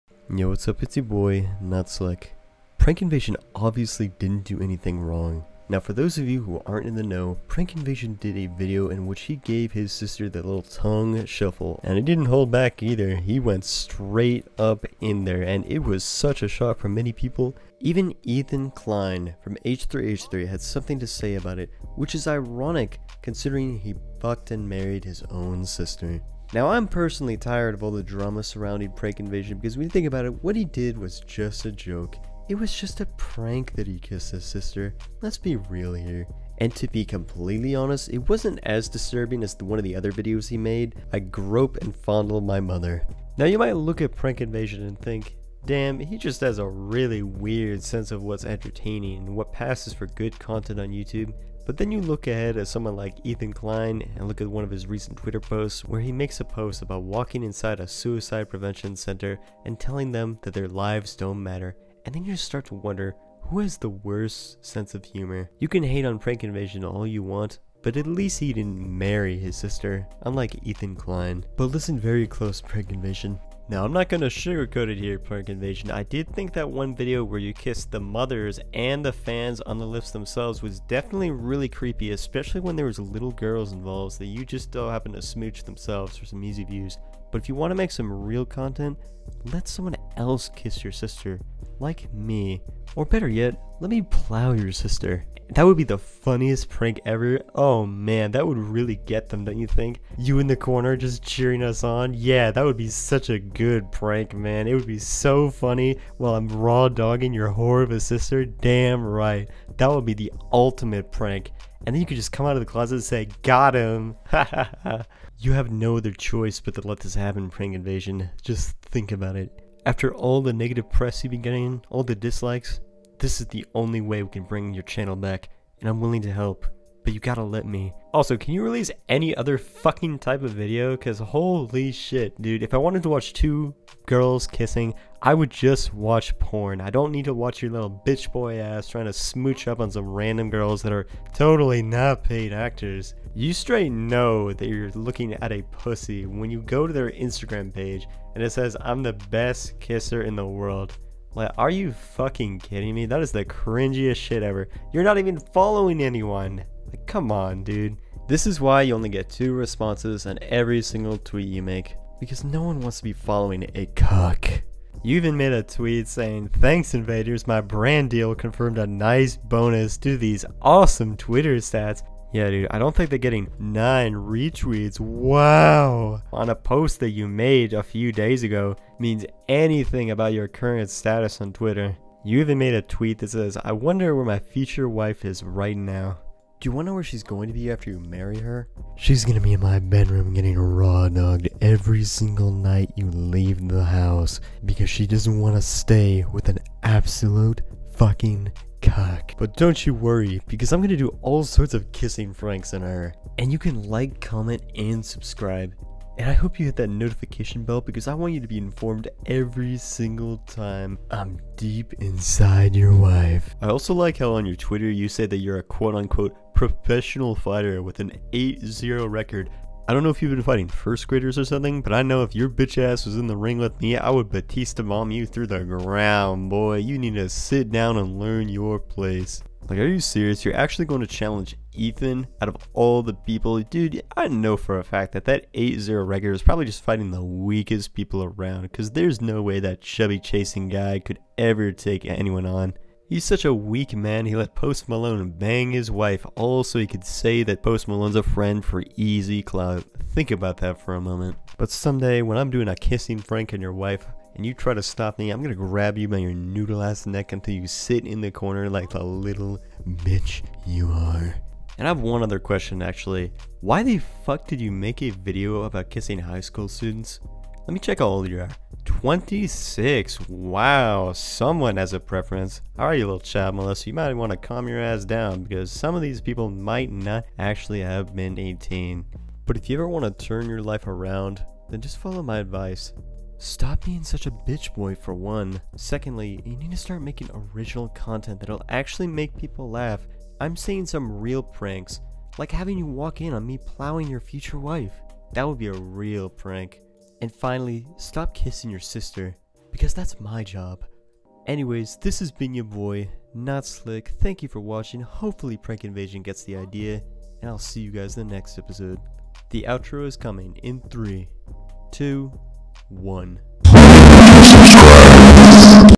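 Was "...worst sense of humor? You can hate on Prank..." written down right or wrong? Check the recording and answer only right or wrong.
right.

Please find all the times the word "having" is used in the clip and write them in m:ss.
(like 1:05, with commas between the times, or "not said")
4:52.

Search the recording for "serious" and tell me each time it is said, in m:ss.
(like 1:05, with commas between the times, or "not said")
3:49.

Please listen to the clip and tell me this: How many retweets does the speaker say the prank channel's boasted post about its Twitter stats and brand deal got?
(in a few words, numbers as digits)
9.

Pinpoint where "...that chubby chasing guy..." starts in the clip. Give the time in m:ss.
3:59.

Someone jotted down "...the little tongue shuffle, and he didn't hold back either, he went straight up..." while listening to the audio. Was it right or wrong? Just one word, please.
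right.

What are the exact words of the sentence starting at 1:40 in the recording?
You in the corner just cheering us on.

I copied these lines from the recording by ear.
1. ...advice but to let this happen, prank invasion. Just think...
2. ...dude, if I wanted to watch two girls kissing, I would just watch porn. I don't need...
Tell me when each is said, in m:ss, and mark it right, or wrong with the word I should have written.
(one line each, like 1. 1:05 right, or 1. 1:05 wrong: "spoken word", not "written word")
1. 1:56 wrong: "choice", not "advice"
2. 2:12 right.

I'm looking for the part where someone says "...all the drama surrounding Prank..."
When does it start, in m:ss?
0:27.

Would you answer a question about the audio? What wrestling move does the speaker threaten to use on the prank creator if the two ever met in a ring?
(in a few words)
Batista bomb.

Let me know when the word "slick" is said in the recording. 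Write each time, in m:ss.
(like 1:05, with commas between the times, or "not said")
0:01, 5:03.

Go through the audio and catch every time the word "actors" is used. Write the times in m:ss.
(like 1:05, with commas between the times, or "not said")
2:22.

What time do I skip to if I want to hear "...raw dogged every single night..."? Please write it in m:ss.
3:10.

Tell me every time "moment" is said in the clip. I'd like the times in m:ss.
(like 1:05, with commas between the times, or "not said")
4:11.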